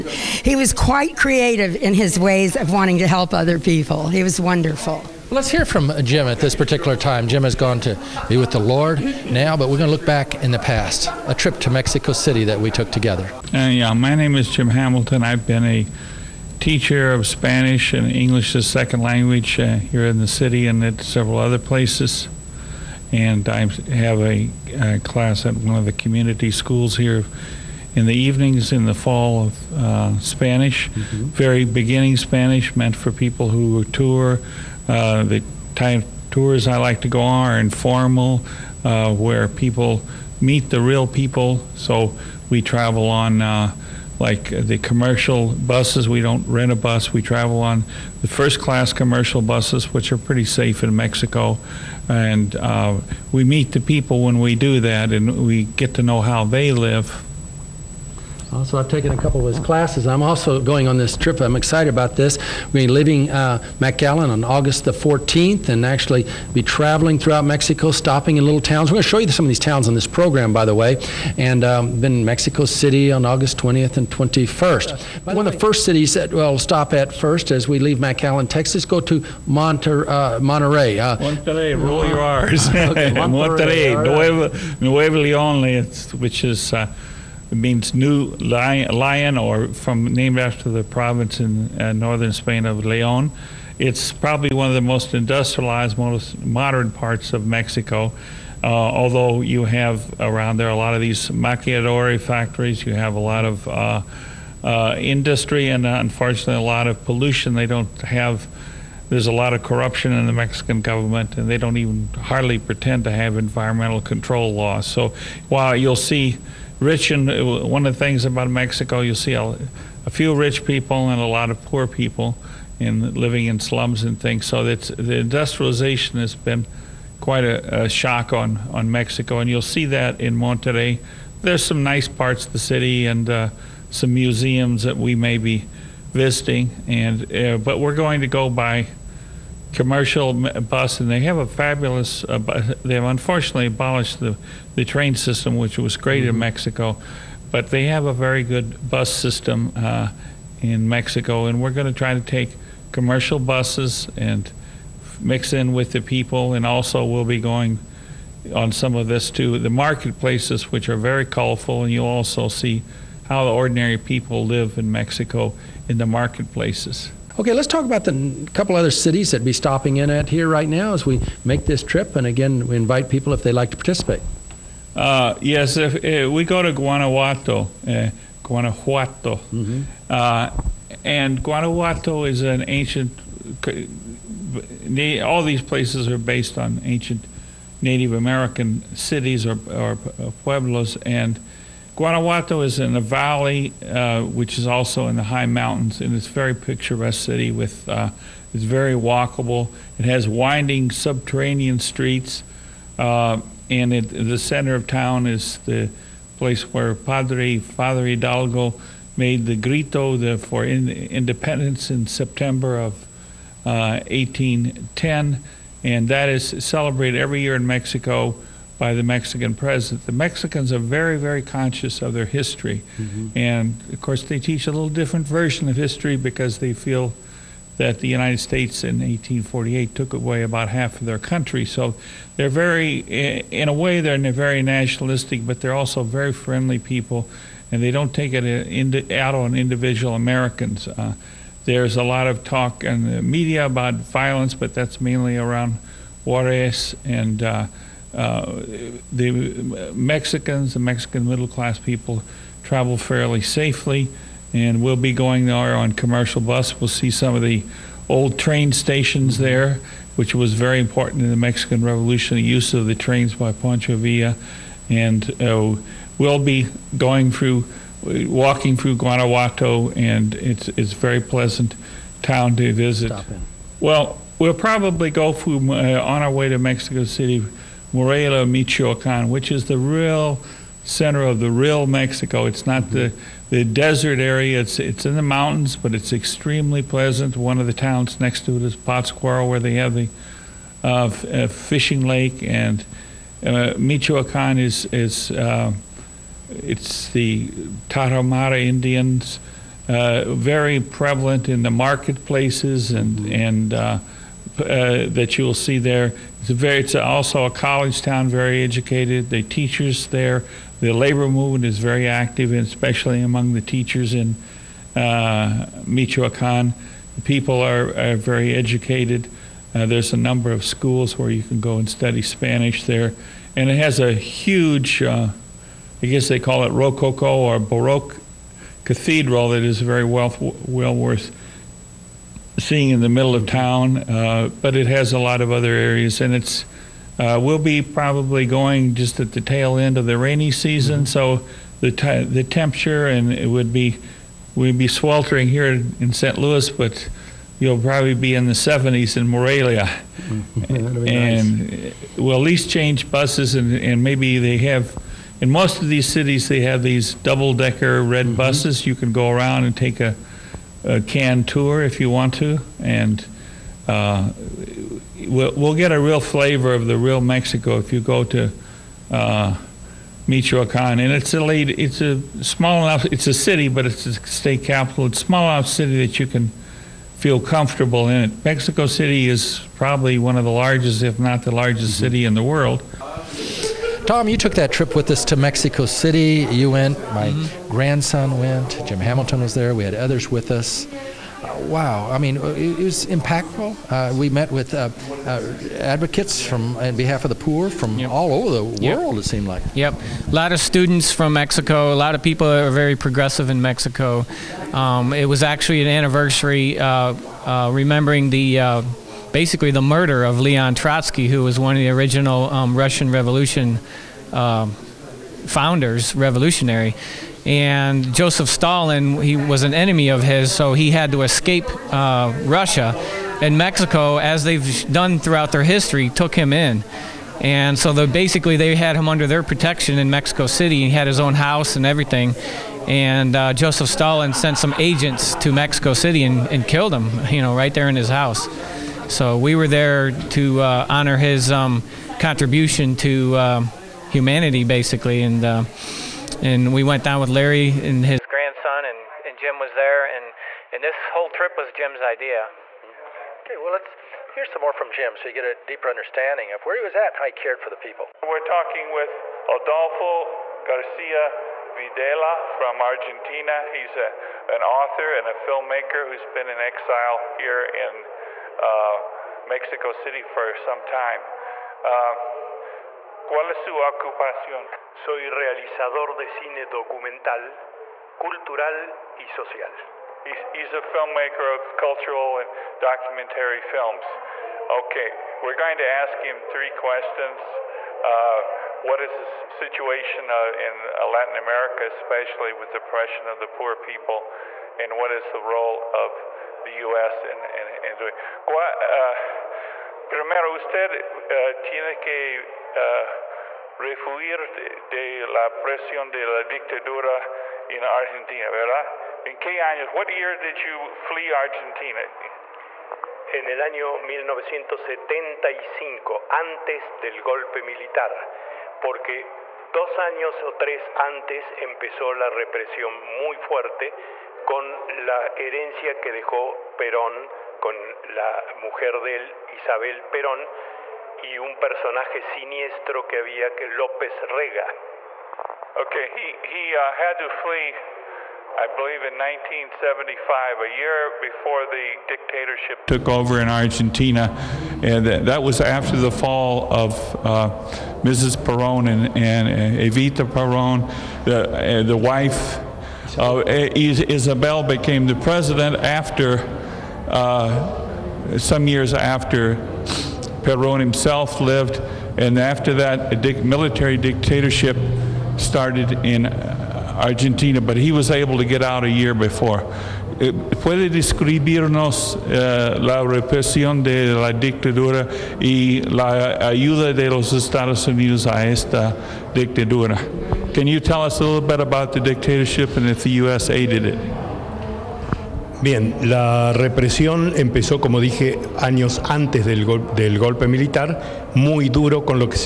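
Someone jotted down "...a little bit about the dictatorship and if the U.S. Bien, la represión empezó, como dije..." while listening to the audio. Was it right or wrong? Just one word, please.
right.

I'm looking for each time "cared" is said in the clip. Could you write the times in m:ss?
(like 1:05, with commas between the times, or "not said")
7:37.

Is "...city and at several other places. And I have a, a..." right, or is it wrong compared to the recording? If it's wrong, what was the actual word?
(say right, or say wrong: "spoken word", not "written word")
right.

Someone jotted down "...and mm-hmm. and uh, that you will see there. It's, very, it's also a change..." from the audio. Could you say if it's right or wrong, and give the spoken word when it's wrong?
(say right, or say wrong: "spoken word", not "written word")
wrong: "college", not "change".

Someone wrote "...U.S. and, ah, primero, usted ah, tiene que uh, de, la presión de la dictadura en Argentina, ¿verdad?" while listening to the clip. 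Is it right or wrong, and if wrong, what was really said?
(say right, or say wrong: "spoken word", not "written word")
right.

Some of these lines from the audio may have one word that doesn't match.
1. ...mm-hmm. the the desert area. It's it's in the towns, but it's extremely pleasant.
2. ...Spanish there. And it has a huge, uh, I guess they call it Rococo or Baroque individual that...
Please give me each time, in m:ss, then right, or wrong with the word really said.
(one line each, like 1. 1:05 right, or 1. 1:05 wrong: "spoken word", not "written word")
1. 4:42 wrong: "mountains", not "towns"
2. 5:22 wrong: "cathedral", not "individual".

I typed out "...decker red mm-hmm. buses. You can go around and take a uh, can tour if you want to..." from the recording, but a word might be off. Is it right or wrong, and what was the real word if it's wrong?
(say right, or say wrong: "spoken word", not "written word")
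right.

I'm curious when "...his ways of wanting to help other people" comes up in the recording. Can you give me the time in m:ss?
0:01.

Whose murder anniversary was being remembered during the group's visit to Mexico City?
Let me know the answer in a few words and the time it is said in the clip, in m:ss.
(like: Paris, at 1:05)
Leon Trotsky, at 6:50.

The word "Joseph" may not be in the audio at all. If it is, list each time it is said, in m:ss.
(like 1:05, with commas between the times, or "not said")
6:58, 7:13.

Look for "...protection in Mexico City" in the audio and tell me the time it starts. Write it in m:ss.
7:09.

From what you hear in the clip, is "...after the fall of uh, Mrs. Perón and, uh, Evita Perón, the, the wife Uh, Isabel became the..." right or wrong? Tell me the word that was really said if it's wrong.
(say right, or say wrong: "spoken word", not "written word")
right.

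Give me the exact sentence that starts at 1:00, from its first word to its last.
I'm also going on this trip.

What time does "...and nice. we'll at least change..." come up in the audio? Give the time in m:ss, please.
5:51.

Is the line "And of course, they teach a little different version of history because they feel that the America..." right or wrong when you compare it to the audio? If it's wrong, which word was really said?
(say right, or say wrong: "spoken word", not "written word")
wrong: "United", not "America".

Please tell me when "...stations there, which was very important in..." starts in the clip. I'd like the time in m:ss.
4:18.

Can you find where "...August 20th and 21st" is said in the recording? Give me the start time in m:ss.
1:13.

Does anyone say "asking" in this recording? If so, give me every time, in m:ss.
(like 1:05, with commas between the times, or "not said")
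not said.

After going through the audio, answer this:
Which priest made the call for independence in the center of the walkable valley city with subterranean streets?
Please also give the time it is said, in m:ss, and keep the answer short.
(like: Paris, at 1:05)
Father Hidalgo, at 3:26.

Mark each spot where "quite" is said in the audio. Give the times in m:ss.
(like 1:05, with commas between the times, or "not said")
0:00, 2:07.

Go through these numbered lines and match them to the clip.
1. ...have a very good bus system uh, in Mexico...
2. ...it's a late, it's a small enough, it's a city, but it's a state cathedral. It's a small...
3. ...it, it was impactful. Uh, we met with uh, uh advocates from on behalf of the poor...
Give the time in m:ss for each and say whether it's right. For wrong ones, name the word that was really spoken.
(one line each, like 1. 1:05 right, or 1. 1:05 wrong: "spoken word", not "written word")
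1. 2:27 right
2. 6:11 wrong: "capital", not "cathedral"
3. 6:32 right.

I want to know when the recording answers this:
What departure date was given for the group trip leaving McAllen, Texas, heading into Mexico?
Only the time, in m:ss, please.
1:04.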